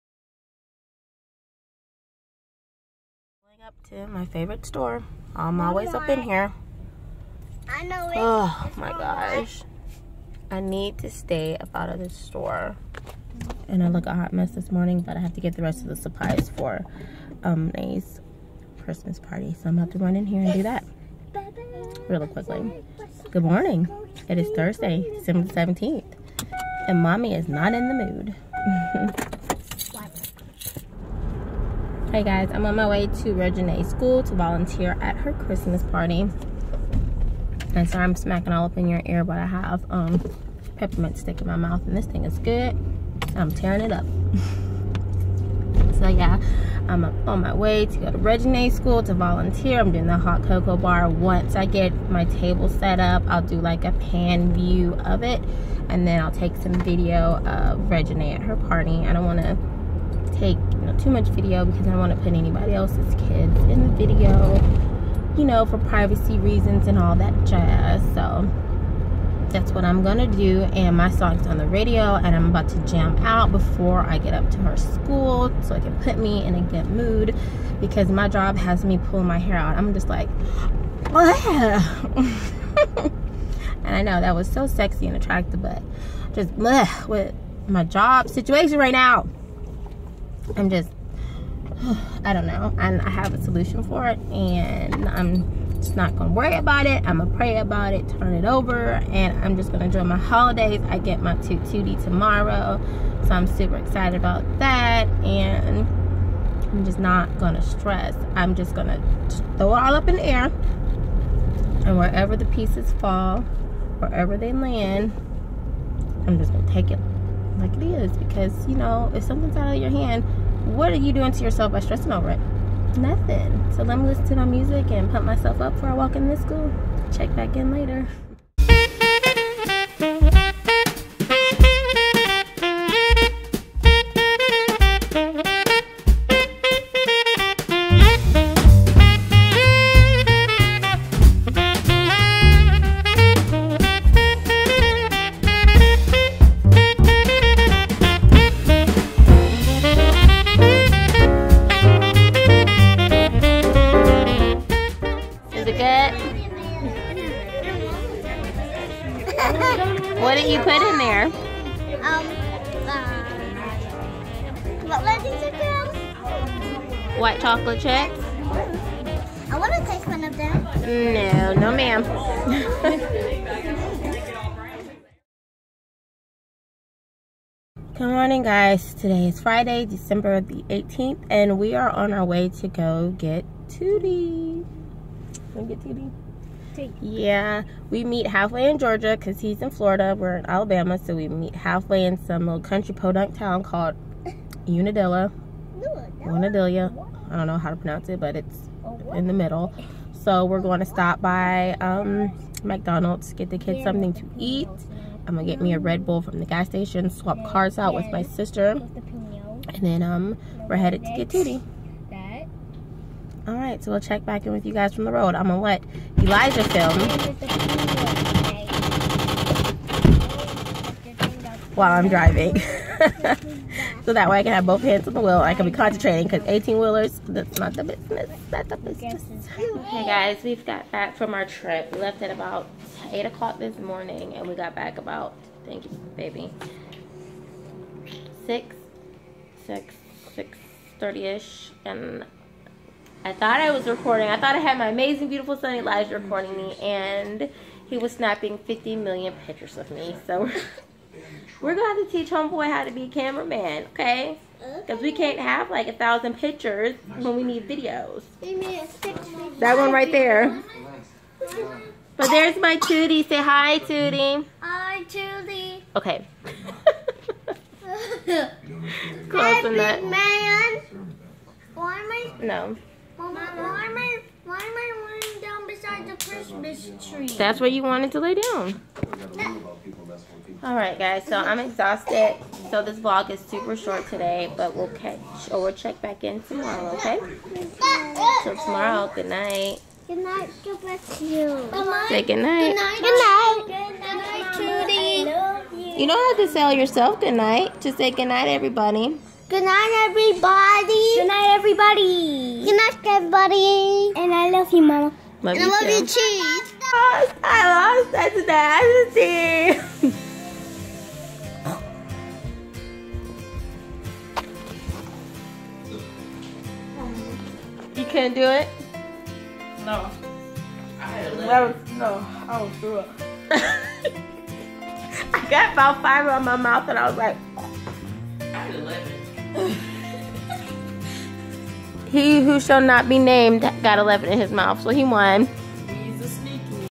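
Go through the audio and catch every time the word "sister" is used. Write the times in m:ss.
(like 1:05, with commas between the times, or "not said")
3:28.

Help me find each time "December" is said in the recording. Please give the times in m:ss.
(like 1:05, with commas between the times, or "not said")
0:25, 2:59.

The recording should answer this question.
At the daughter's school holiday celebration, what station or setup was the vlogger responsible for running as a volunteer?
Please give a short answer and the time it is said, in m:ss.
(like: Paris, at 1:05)
hot cocoa bar, at 0:50.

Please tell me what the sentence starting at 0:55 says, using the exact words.
And then I'll take some video of Regine at her party.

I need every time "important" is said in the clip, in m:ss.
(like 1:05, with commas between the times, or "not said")
not said.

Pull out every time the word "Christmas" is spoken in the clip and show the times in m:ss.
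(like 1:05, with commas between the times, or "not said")
0:18, 0:35.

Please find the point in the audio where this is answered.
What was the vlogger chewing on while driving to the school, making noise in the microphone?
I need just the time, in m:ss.
0:40.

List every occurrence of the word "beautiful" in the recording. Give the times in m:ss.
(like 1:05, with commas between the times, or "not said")
4:05.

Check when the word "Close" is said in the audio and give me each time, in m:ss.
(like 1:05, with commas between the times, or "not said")
4:29.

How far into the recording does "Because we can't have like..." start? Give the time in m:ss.
4:14.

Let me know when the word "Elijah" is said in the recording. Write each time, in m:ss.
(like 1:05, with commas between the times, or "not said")
3:36, 4:05.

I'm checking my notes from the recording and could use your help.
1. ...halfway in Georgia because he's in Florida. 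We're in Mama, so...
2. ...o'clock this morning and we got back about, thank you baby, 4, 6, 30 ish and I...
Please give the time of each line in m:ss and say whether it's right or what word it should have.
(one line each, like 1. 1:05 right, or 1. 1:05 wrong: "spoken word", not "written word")
1. 3:08 wrong: "Alabama", not "Mama"
2. 3:53 wrong: "6", not "4".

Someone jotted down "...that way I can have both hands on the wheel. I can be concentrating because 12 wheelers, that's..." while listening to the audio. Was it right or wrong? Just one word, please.
wrong.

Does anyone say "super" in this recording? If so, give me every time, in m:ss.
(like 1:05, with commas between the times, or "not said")
1:43, 4:43.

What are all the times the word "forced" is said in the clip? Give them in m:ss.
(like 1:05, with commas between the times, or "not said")
not said.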